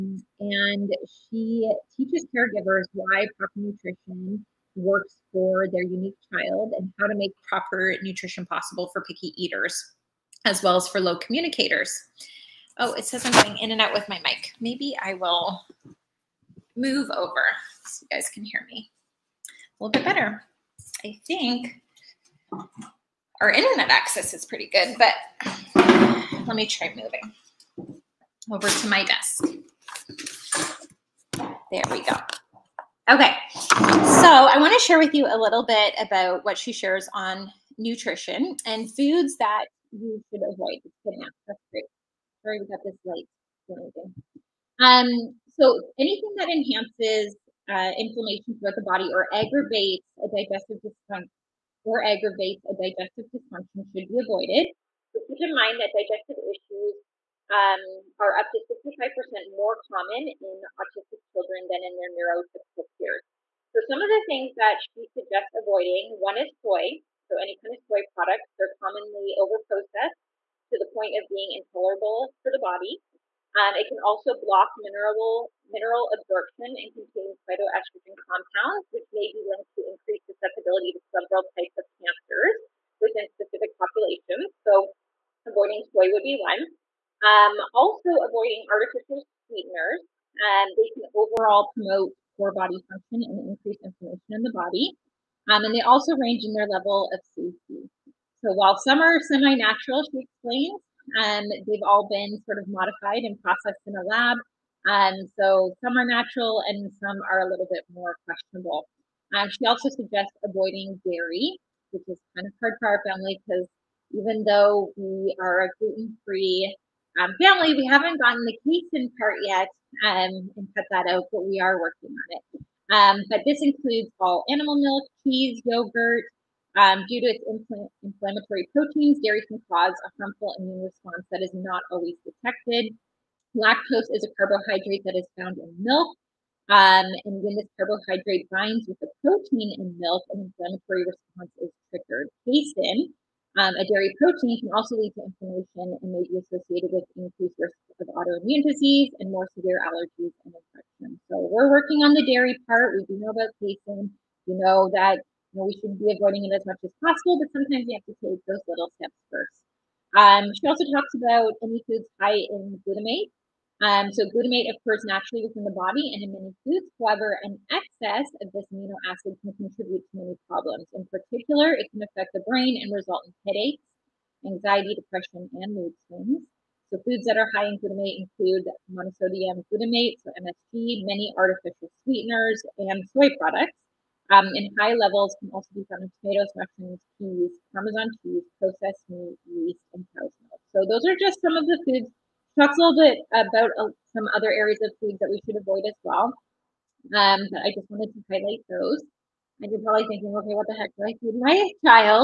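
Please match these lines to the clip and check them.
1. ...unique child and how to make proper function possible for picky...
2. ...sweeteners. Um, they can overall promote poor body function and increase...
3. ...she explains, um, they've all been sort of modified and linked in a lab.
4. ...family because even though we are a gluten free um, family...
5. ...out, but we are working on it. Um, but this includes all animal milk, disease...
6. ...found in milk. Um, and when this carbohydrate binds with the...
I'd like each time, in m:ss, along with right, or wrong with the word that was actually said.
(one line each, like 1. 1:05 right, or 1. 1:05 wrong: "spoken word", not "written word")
1. 0:05 wrong: "nutrition", not "function"
2. 1:29 right
3. 1:40 wrong: "processed", not "linked"
4. 1:53 right
5. 2:01 wrong: "cheese", not "disease"
6. 2:15 right.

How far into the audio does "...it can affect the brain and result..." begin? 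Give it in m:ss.
2:51.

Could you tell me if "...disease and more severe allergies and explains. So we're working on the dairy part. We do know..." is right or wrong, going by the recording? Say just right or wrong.
wrong.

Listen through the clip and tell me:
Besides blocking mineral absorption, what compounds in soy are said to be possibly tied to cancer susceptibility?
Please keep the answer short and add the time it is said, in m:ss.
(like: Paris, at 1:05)
phytoestrogen compounds, at 1:17.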